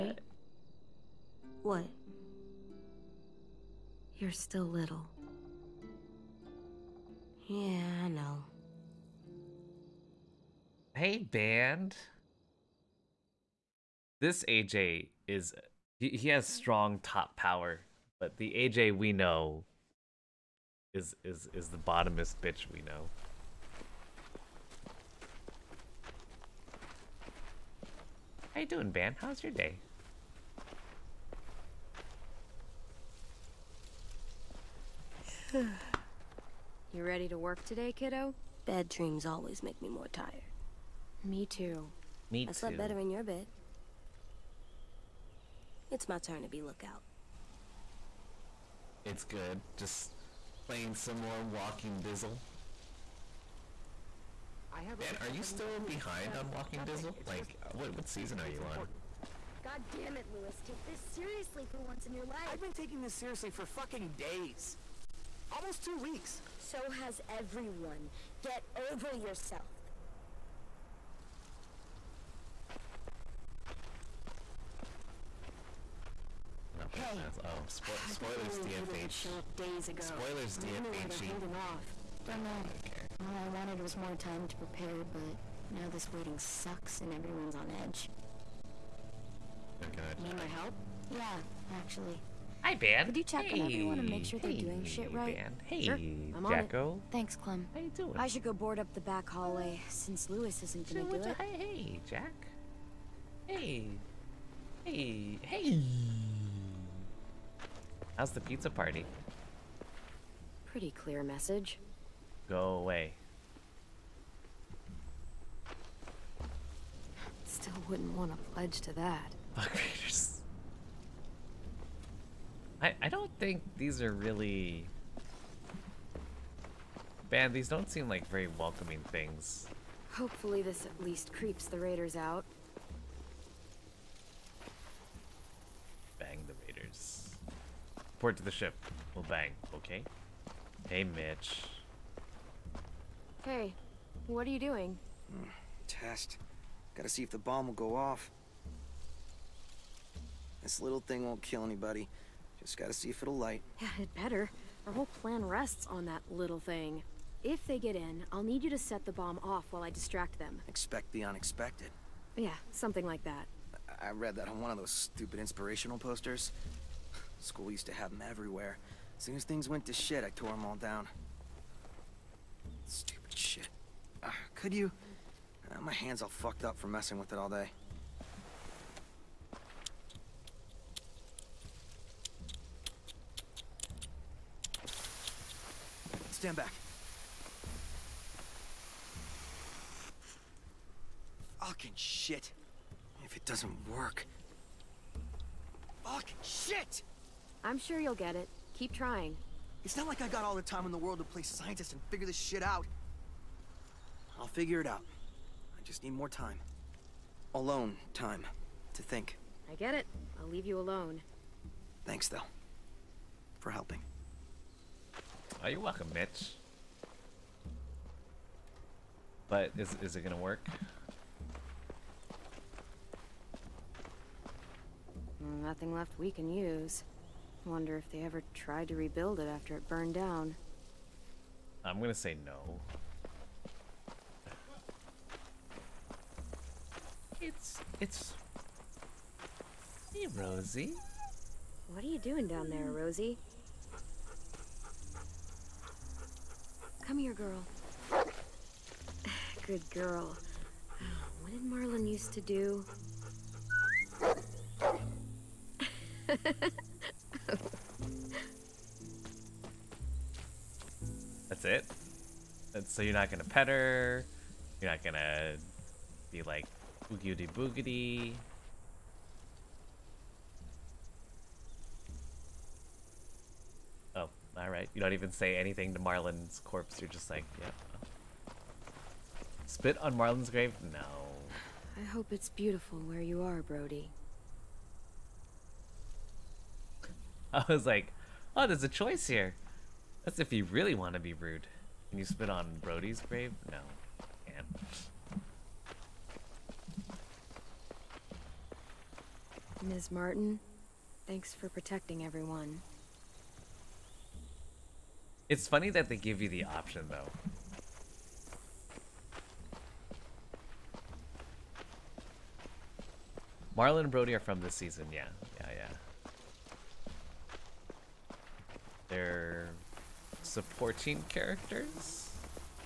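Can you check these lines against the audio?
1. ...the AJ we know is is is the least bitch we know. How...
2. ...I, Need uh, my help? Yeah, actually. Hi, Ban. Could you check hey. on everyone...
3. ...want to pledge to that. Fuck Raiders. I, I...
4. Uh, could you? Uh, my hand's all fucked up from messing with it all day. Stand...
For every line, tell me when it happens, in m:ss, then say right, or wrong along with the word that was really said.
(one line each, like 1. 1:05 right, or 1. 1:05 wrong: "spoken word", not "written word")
1. 0:18 wrong: "bottomest", not "least"
2. 1:30 right
3. 1:58 right
4. 2:54 right.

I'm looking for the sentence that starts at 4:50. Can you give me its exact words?
That's if you really want to be rude.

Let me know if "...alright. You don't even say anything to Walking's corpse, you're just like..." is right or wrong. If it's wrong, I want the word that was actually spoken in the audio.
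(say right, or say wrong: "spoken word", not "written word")
wrong: "Marlon", not "Walking".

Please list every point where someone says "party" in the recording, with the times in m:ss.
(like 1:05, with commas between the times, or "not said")
1:48.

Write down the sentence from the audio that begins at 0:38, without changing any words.
Bad dreams always make me more tired.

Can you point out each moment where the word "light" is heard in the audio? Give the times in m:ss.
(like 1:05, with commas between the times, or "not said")
2:33.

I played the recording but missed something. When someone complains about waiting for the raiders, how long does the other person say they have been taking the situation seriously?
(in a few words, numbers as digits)
Almost two weeks.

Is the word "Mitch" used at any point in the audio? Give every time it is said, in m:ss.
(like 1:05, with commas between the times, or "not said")
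2:21, 3:36.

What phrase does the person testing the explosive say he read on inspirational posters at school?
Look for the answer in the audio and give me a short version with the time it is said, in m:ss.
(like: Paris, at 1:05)
Expect the unexpected, at 2:40.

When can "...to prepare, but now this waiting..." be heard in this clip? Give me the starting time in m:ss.
1:24.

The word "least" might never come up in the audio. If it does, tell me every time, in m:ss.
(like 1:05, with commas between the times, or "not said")
2:11.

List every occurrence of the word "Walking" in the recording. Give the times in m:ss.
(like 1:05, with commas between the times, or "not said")
0:51, 0:56.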